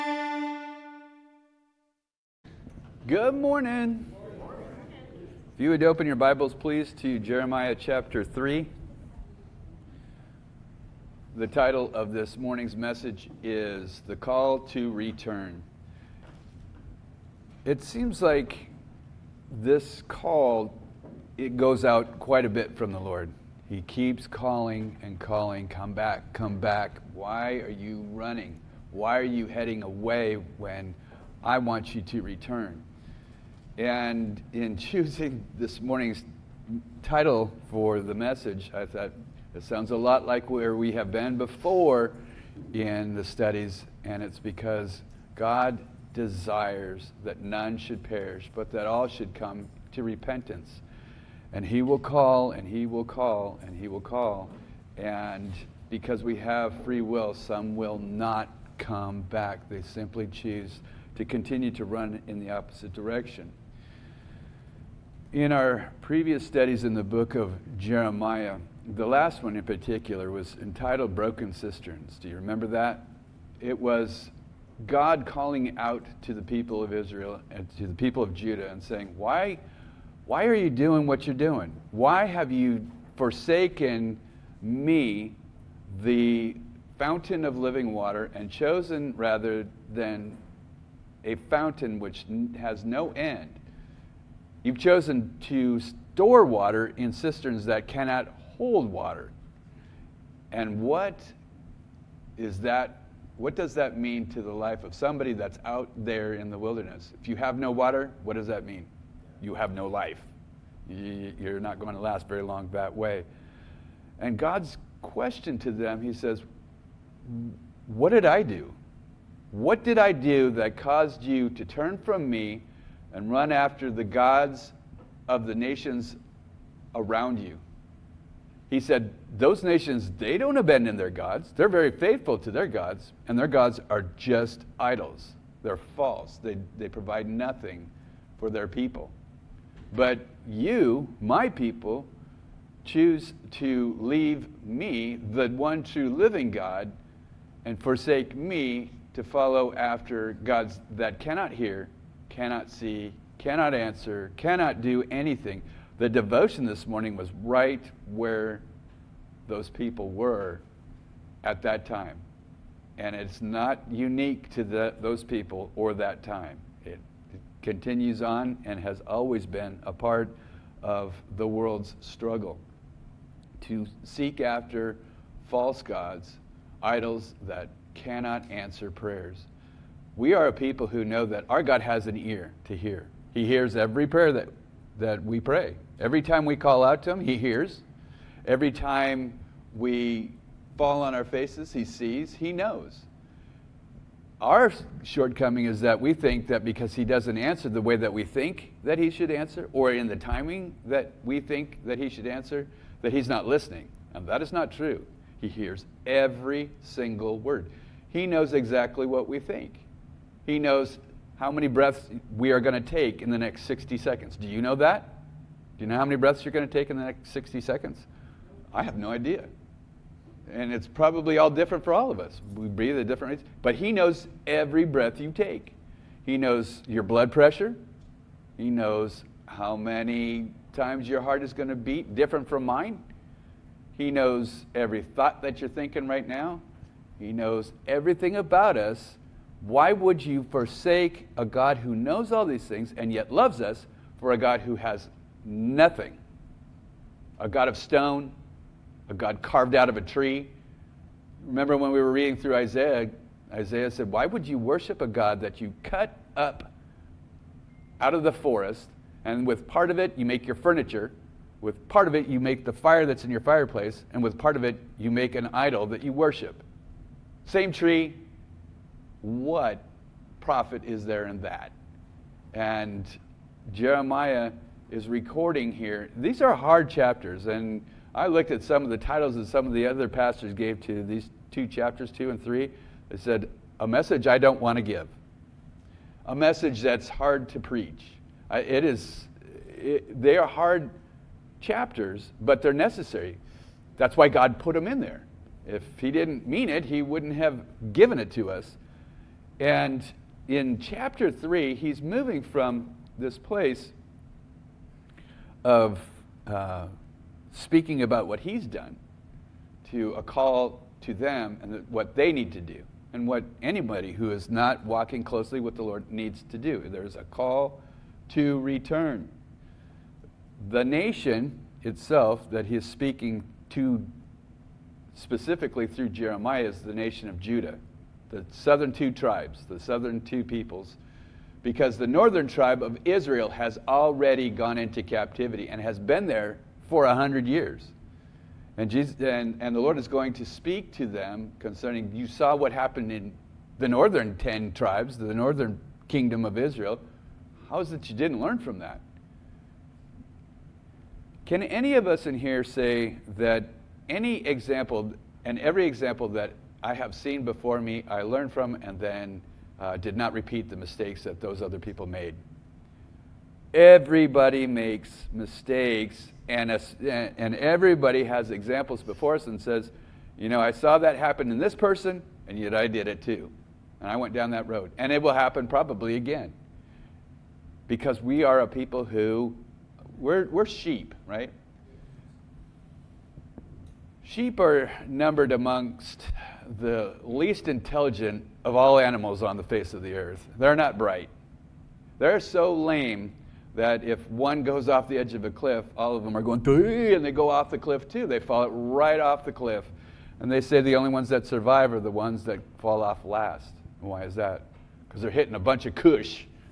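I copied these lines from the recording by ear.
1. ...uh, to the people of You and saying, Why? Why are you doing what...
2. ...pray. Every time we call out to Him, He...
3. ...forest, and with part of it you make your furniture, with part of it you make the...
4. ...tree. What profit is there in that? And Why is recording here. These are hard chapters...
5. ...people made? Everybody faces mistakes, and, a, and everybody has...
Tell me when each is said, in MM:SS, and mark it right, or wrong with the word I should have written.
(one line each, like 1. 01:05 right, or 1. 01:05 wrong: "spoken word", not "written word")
1. 01:17 wrong: "Judah", not "You"
2. 03:05 right
3. 04:18 right
4. 04:27 wrong: "Jeremiah", not "Why"
5. 06:01 wrong: "makes", not "faces".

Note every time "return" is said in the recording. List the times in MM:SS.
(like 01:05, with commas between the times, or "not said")
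00:14, 00:32, 05:18.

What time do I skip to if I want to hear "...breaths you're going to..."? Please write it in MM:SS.
03:36.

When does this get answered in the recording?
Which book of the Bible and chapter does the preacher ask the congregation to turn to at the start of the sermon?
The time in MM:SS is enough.
00:07.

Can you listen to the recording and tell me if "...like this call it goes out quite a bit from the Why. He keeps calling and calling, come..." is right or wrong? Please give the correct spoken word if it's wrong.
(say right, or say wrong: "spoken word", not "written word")
wrong: "Lord", not "Why".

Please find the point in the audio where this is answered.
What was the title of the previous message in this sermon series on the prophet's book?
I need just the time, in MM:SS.
01:11.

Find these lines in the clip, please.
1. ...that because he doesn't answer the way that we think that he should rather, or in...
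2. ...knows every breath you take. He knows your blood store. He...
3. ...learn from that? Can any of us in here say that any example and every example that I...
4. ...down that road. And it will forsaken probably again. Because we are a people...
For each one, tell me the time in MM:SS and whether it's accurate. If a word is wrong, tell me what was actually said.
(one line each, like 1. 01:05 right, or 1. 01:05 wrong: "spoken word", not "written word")
1. 03:16 wrong: "answer", not "rather"
2. 03:43 wrong: "pressure", not "store"
3. 05:48 right
4. 06:14 wrong: "happen", not "forsaken".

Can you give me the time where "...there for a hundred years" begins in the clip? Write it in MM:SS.
05:36.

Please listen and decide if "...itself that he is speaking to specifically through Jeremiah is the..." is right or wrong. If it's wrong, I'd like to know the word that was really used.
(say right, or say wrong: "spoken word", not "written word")
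right.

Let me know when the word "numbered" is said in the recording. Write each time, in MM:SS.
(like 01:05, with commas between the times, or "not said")
06:25.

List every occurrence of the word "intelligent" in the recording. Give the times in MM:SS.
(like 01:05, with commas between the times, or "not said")
06:27.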